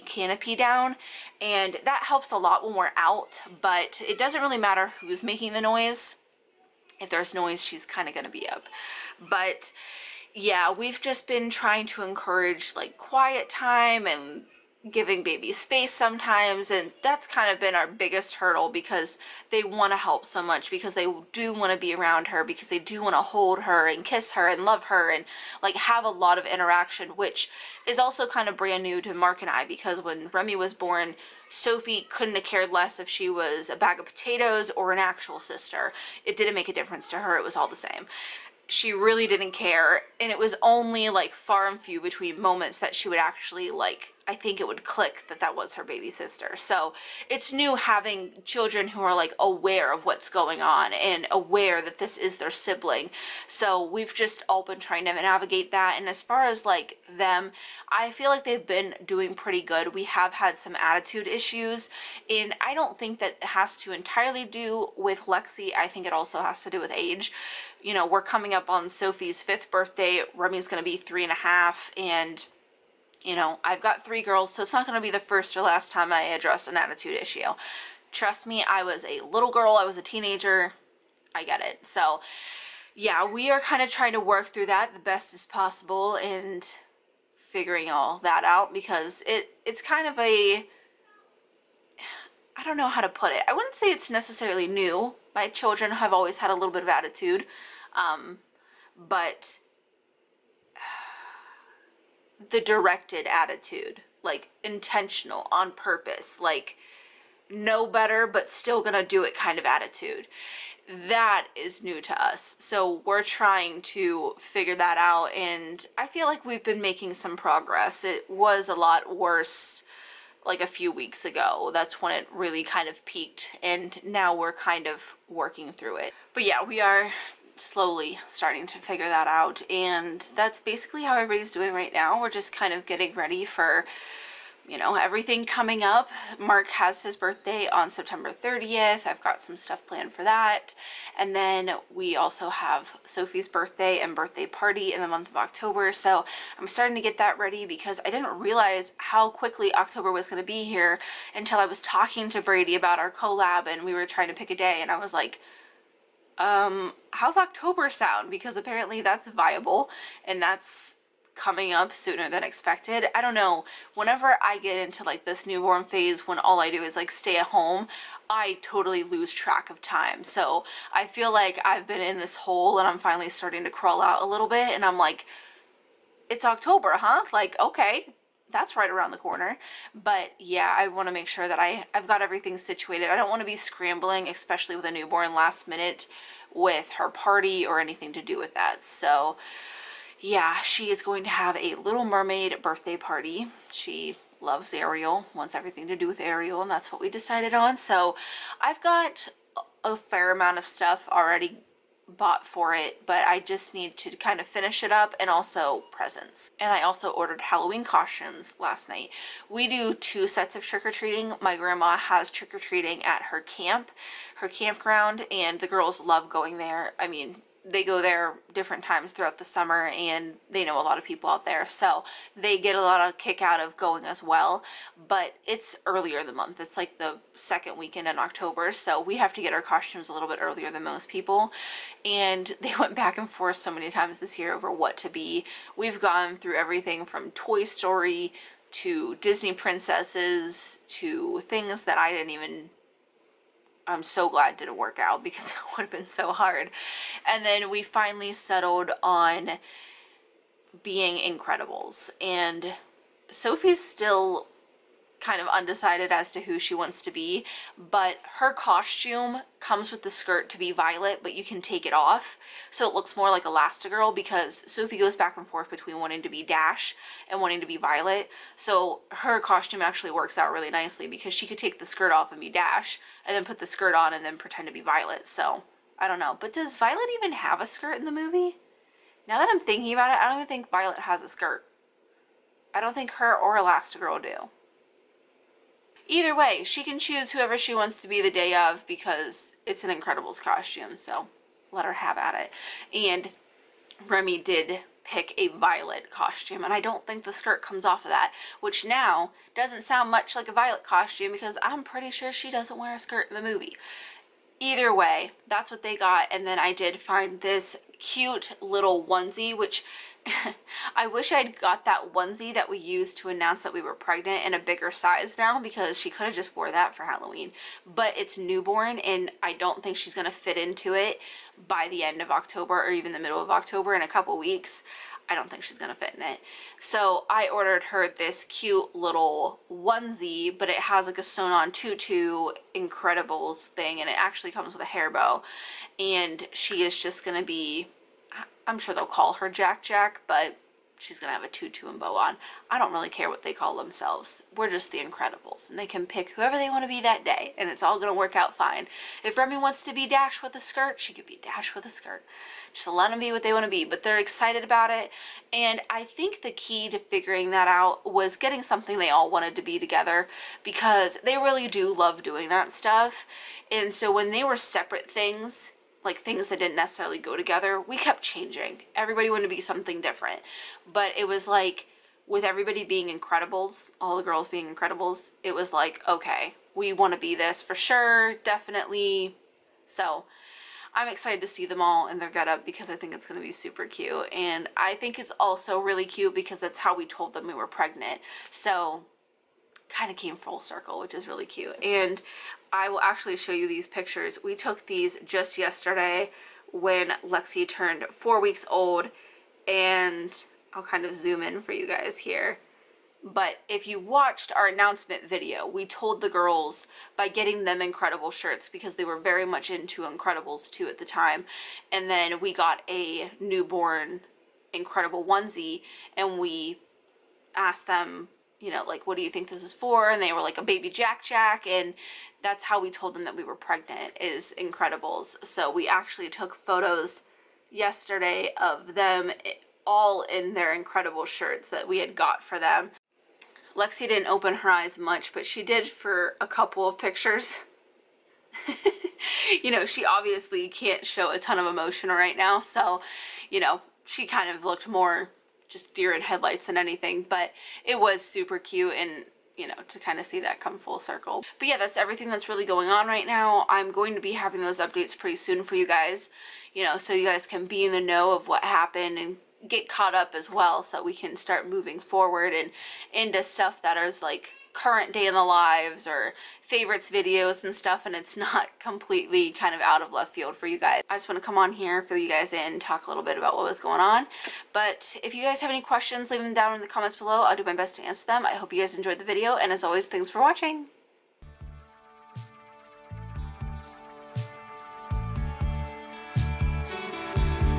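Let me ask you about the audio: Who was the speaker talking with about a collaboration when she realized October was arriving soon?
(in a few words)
Brady.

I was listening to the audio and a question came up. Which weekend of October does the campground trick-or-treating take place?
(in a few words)
The second weekend.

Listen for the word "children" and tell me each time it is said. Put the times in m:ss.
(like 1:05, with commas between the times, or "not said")
0:48, 1:35.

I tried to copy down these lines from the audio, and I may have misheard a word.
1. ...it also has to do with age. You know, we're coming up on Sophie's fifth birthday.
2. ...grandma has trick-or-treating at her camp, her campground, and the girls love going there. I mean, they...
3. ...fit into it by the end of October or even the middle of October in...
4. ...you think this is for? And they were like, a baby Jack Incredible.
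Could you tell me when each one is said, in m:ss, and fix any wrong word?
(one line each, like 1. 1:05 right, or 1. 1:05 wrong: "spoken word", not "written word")
1. 1:06 right
2. 3:31 right
3. 5:20 right
4. 6:59 wrong: "Jack", not "Incredible".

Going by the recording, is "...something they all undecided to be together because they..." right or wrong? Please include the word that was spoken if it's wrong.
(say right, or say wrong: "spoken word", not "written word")
wrong: "wanted", not "undecided".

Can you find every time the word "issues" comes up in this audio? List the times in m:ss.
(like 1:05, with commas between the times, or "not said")
1:01, 1:17.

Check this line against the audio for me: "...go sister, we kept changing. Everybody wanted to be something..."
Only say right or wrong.
wrong.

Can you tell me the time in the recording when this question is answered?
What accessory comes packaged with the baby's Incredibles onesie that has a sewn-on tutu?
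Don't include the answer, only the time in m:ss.
5:34.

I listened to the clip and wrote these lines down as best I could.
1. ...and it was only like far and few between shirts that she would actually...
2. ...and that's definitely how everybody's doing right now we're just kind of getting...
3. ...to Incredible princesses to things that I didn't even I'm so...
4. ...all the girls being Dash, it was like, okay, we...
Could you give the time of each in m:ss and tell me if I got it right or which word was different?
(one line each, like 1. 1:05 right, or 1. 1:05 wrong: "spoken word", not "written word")
1. 0:40 wrong: "moments", not "shirts"
2. 2:09 wrong: "basically", not "definitely"
3. 3:58 wrong: "Disney", not "Incredible"
4. 6:13 wrong: "Incredibles", not "Dash".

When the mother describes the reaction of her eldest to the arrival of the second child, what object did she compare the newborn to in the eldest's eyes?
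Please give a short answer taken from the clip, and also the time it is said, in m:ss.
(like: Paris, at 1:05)
A bag of potatoes, at 0:33.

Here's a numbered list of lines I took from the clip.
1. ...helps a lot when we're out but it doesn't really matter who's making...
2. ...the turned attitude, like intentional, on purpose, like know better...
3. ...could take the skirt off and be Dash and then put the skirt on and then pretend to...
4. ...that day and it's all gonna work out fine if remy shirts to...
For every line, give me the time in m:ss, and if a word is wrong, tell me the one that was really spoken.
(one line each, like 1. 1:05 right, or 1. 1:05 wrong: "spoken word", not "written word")
1. 0:02 right
2. 1:42 wrong: "directed", not "turned"
3. 4:31 right
4. 5:47 wrong: "wants", not "shirts".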